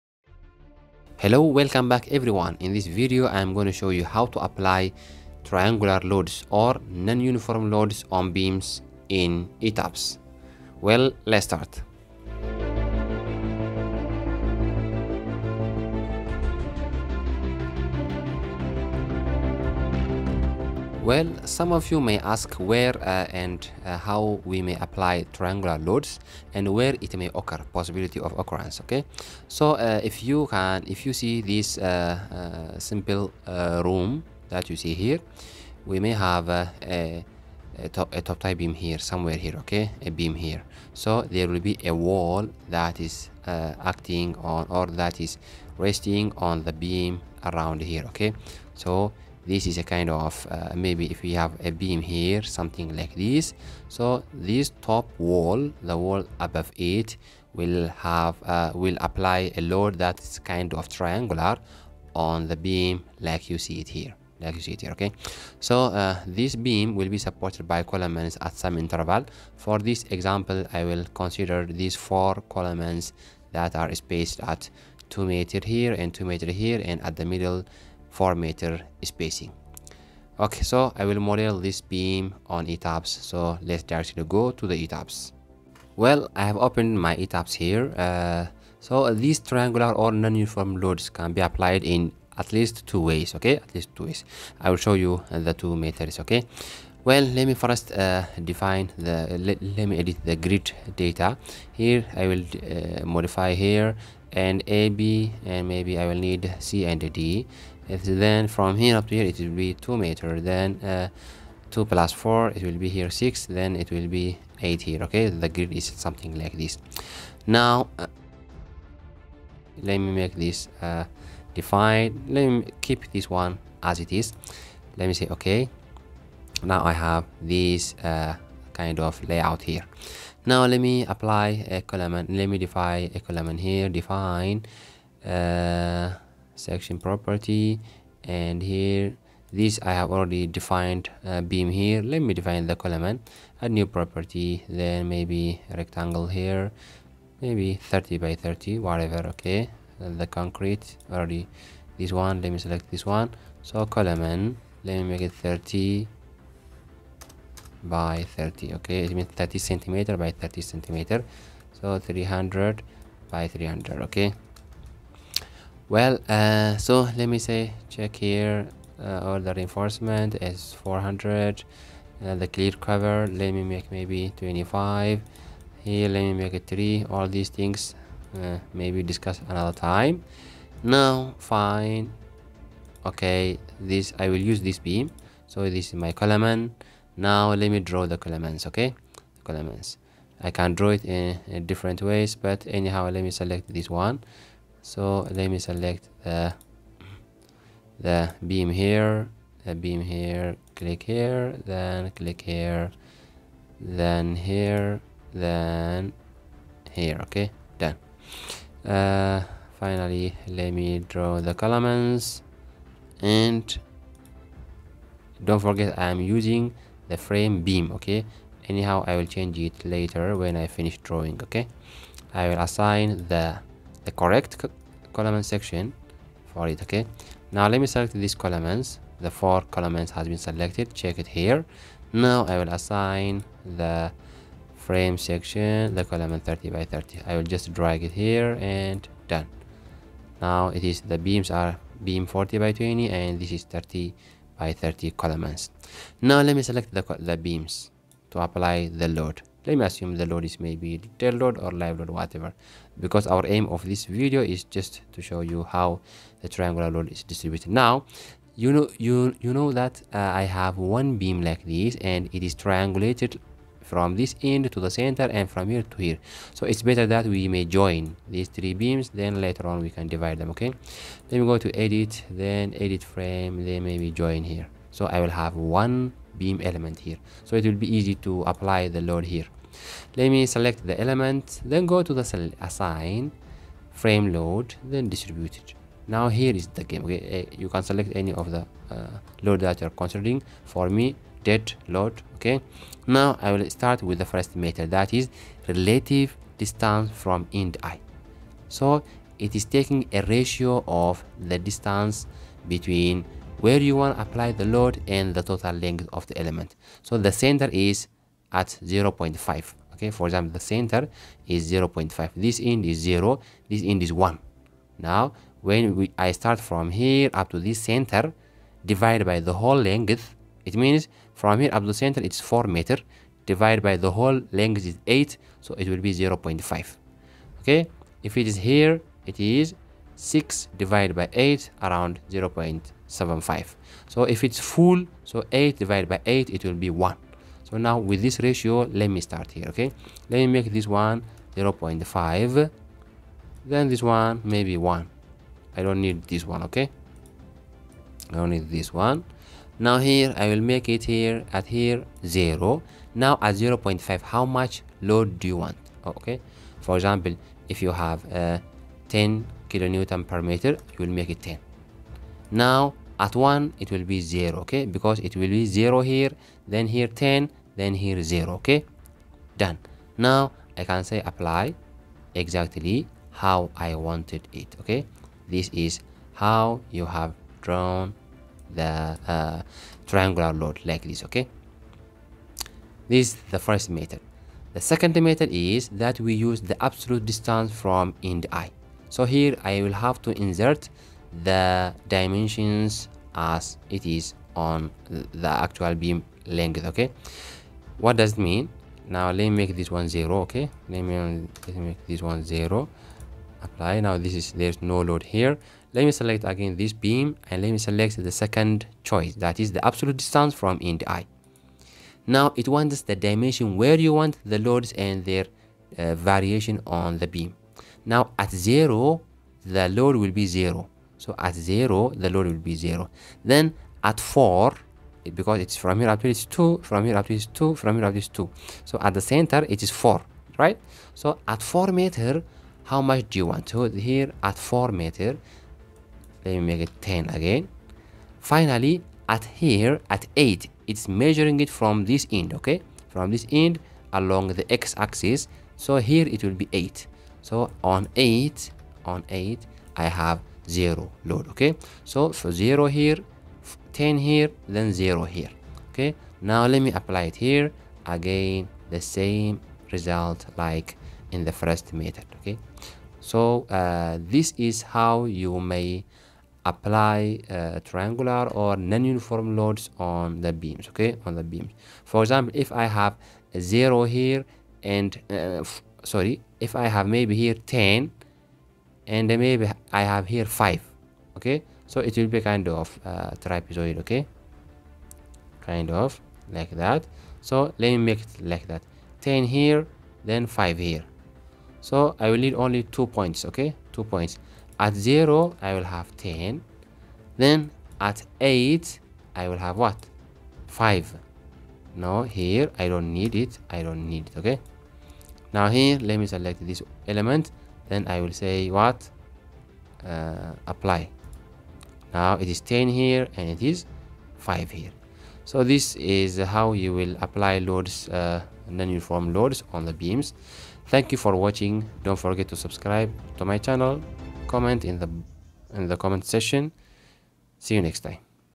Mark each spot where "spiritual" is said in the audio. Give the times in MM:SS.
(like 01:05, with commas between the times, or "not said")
not said.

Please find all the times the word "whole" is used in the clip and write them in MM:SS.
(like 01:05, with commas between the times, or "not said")
05:19, 05:24.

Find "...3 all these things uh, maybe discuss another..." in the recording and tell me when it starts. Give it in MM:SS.
02:56.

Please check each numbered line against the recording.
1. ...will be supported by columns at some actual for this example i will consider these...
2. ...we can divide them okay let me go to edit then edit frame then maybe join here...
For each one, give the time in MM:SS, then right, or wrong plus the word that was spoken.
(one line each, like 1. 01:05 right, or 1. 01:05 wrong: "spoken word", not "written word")
1. 01:06 wrong: "interval", not "actual"
2. 04:29 right.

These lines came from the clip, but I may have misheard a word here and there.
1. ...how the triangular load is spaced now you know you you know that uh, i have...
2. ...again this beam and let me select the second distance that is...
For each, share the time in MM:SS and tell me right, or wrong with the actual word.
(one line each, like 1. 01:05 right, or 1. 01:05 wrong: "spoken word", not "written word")
1. 04:15 wrong: "distributed", not "spaced"
2. 06:46 wrong: "choice", not "distance".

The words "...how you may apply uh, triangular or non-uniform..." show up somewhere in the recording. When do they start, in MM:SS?
07:44.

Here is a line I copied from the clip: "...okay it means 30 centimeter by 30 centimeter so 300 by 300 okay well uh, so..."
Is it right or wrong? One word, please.
right.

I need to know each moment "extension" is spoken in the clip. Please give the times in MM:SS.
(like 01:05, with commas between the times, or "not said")
not said.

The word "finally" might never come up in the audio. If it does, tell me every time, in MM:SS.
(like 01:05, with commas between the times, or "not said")
03:29, 07:18.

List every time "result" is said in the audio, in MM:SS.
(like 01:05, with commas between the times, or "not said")
07:39.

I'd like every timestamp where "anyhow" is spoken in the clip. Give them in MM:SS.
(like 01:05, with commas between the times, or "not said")
03:12, 03:38.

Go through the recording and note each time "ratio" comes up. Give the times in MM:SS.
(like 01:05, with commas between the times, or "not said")
05:00, 05:38.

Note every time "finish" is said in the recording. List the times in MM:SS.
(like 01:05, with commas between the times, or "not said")
03:40.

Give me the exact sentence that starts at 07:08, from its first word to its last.
So at the center, it is 4, right?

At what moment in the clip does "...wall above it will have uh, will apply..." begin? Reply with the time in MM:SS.
00:55.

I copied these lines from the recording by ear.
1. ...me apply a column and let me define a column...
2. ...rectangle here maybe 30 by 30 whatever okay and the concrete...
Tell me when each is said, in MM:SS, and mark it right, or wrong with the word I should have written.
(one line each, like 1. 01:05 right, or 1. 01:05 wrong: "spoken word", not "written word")
1. 02:10 right
2. 02:25 right.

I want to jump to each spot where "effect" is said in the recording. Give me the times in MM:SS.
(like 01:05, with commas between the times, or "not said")
not said.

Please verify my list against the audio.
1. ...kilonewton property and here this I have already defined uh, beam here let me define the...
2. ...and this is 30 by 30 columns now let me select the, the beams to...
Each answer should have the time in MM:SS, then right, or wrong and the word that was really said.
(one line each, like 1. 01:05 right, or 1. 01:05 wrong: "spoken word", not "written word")
1. 02:16 wrong: "section", not "kilonewton"
2. 04:03 right.